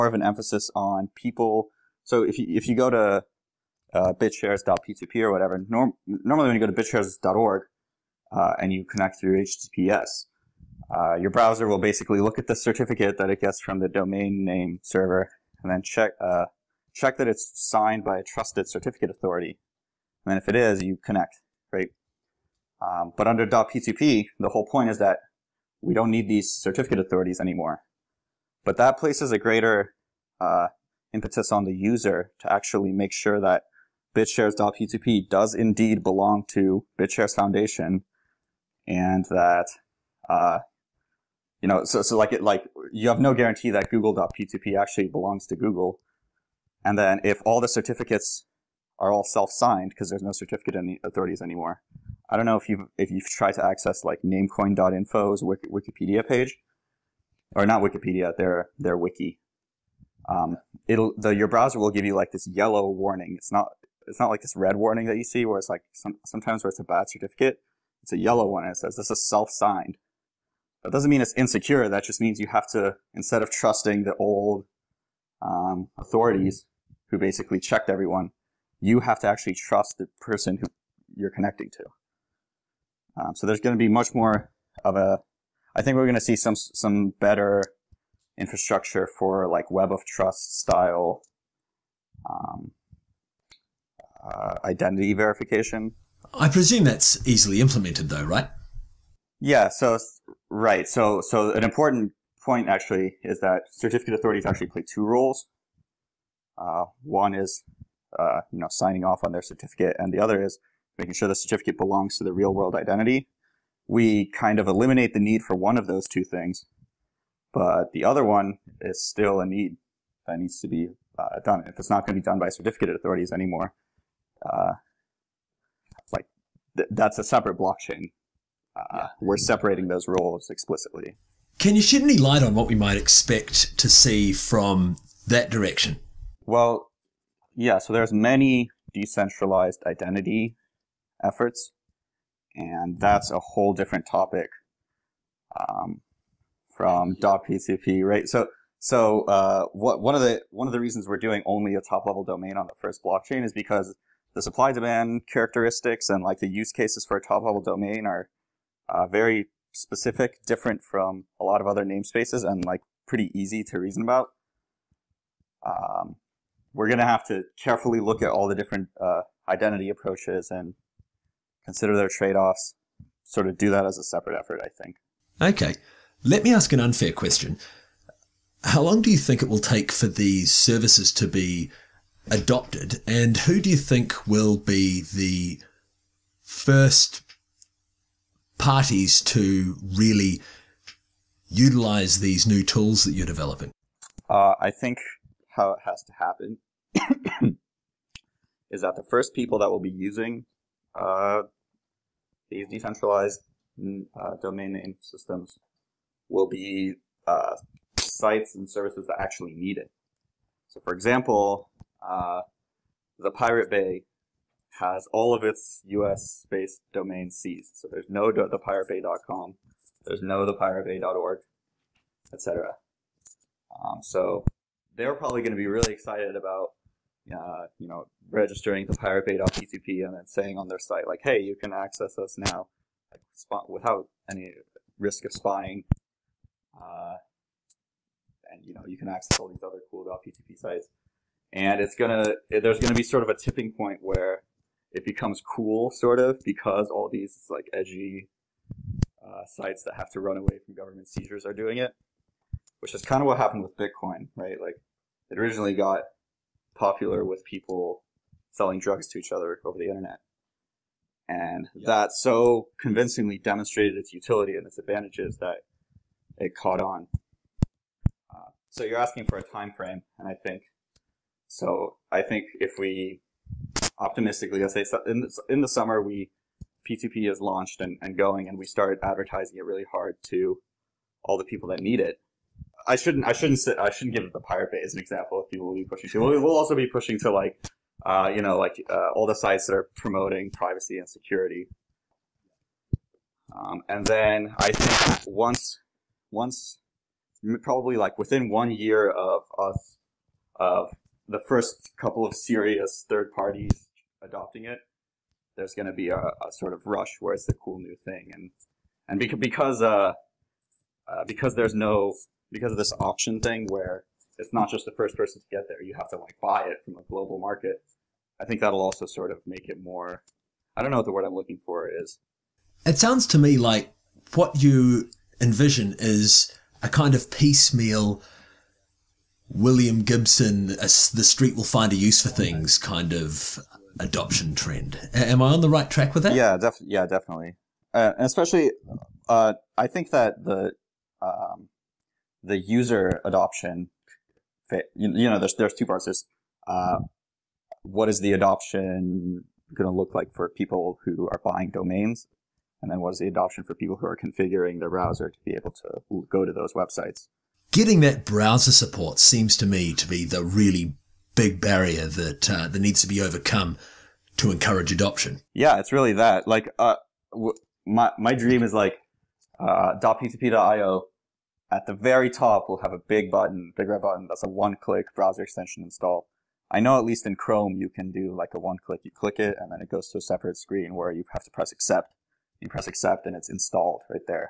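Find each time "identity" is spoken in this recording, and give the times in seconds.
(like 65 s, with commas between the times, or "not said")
94 s, 112 s, 139 s, 169 s.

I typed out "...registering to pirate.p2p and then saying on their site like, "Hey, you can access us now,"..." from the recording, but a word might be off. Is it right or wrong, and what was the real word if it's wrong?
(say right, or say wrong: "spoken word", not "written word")
right.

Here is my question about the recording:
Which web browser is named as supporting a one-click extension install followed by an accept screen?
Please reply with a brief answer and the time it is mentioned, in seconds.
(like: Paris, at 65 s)
Chrome, at 377 s.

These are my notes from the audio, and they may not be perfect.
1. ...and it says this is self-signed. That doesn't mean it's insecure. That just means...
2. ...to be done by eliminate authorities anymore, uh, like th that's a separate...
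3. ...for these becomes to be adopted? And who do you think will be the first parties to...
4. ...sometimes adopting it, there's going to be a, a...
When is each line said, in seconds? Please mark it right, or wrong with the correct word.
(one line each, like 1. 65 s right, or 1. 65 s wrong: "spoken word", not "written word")
1. 68 s right
2. 122 s wrong: "certificate", not "eliminate"
3. 179 s wrong: "services", not "becomes"
4. 303 s wrong: "parties", not "sometimes".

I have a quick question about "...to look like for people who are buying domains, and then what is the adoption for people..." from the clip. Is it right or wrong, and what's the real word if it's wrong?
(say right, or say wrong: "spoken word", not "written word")
right.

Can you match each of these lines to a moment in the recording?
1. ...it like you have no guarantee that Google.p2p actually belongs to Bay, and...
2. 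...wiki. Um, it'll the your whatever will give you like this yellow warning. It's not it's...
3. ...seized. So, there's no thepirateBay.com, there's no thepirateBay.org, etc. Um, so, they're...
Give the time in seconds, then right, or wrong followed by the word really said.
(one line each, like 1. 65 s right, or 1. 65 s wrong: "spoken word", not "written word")
1. 42 s wrong: "Google", not "Bay"
2. 58 s wrong: "browser", not "whatever"
3. 217 s right.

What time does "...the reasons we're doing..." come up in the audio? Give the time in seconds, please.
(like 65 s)
150 s.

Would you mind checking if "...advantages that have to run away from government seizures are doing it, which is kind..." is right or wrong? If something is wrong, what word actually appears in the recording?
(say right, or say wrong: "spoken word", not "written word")
wrong: "sites", not "advantages".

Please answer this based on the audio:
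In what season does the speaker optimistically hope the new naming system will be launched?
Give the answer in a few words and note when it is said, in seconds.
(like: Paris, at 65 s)
Summer, at 275 s.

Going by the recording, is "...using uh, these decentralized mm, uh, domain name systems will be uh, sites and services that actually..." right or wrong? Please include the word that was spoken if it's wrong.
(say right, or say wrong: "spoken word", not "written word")
right.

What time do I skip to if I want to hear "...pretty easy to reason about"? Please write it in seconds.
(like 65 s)
163 s.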